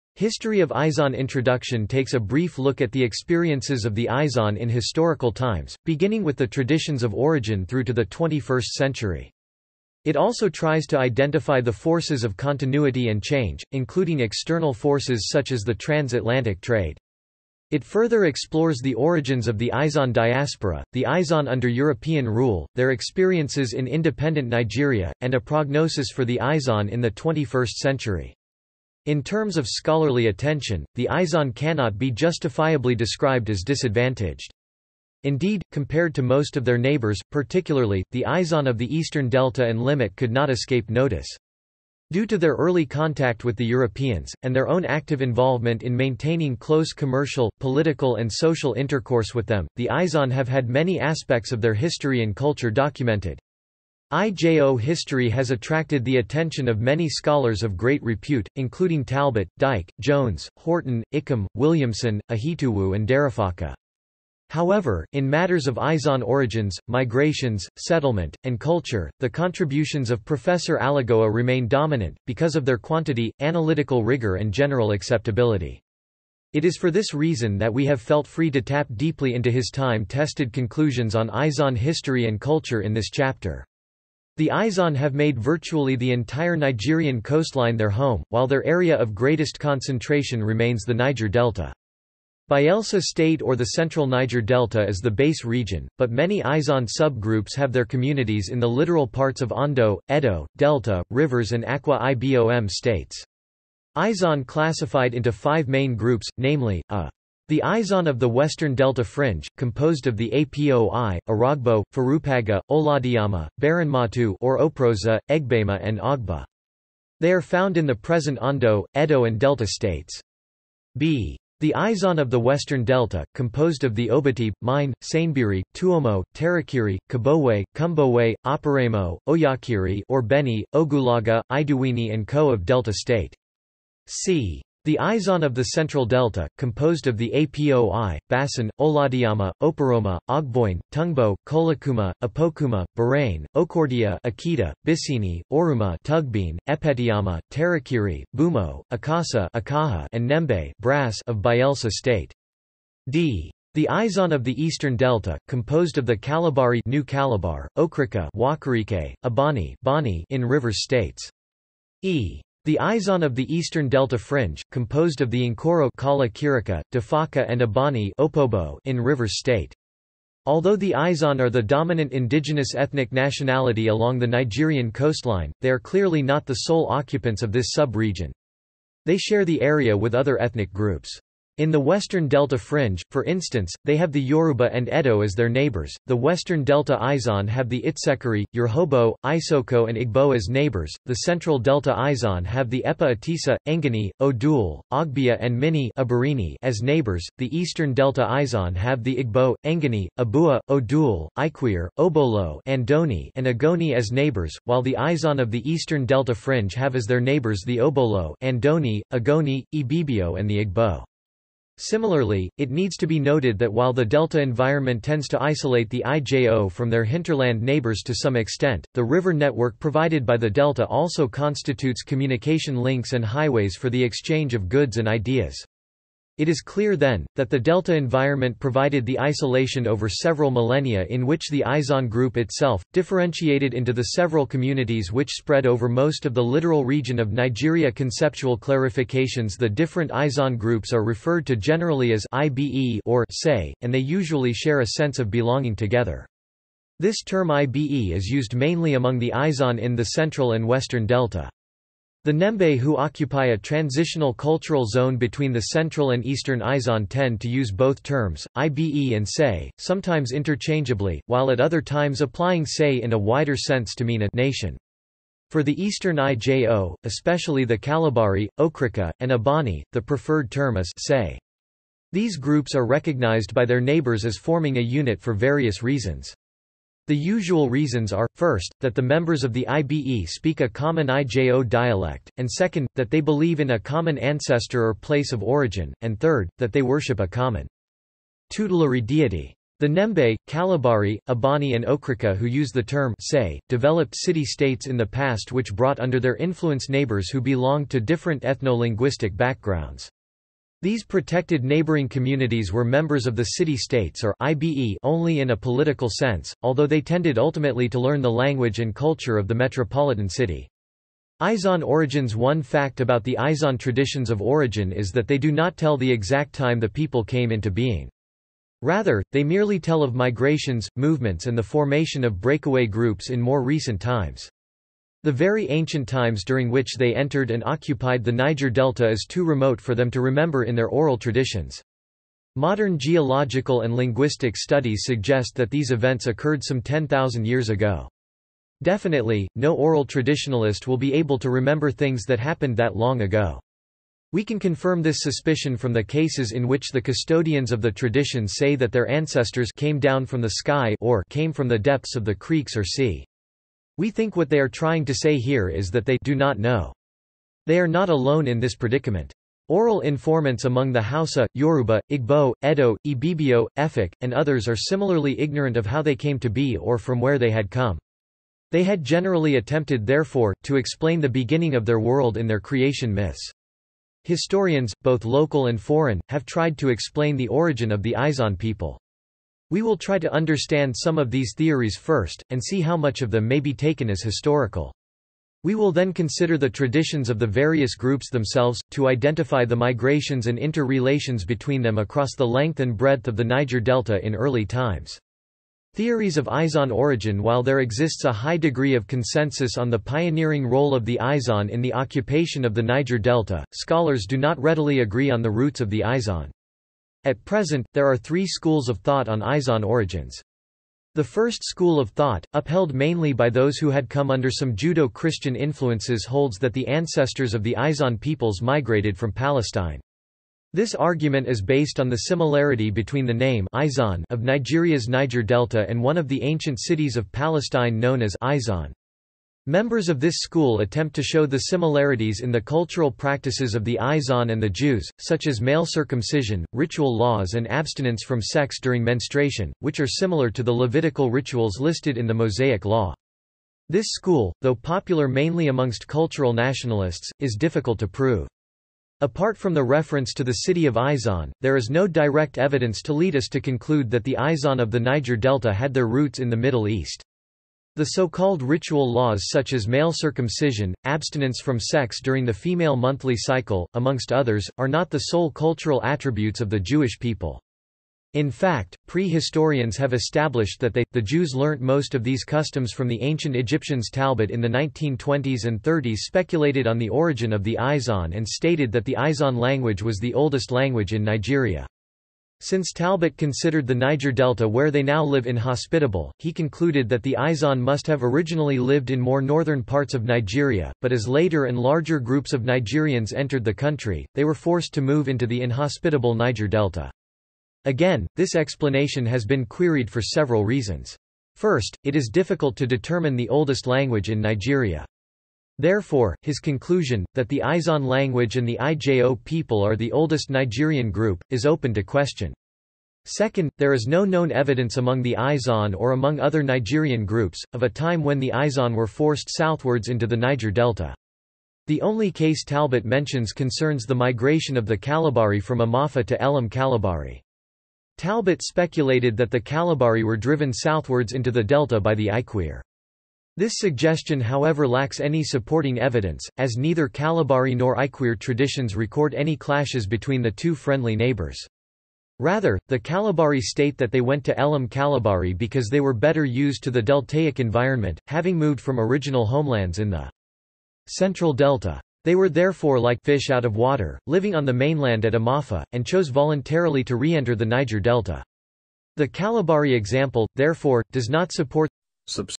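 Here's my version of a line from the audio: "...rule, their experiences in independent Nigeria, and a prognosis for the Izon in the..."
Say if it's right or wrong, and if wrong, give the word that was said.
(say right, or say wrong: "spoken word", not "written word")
right.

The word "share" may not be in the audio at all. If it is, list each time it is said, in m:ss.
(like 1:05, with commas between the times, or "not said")
2:59, 4:04.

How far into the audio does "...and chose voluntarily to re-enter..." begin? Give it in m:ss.
9:15.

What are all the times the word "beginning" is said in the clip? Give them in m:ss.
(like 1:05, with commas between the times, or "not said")
0:05, 6:11.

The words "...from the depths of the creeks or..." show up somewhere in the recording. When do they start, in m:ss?
5:51.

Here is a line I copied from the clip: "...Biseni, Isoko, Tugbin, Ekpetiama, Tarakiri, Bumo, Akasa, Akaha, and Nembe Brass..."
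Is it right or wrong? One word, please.
wrong.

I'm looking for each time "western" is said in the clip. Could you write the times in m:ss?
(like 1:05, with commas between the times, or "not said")
1:48, 2:02, 3:01, 3:06, 4:10.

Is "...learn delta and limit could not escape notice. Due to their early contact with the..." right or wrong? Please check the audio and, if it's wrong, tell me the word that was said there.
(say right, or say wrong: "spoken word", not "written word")
wrong: "eastern", not "learn".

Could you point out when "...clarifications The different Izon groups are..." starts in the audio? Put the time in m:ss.
3:58.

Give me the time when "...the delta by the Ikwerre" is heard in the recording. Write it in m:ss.
8:51.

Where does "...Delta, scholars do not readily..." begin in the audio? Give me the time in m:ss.
6:43.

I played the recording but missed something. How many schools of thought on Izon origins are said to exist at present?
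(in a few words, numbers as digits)
3.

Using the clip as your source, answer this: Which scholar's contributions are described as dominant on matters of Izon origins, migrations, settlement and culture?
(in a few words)
Professor Alagoa.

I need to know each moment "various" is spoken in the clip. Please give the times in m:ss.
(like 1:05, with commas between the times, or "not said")
4:35, 6:27.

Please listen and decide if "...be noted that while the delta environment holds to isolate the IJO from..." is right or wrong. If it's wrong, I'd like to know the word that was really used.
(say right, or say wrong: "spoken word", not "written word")
wrong: "tends", not "holds".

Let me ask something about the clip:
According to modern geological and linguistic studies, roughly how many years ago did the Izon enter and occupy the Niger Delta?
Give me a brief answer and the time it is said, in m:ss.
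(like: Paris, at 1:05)
10,000 years, at 5:36.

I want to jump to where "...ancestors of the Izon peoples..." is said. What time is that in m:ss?
6:56.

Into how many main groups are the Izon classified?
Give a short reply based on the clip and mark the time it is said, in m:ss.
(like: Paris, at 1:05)
5, at 1:45.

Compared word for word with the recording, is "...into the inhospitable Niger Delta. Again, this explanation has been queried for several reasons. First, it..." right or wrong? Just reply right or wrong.
right.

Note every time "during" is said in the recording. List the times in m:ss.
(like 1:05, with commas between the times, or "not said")
5:26, 7:18, 7:42.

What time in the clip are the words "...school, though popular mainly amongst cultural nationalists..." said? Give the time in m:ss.
7:24.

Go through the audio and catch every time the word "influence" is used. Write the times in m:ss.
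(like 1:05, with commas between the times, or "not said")
4:56, 6:55.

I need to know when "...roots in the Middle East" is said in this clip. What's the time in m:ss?
7:36.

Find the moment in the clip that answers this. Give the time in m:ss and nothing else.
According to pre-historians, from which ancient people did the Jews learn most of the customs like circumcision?
7:53.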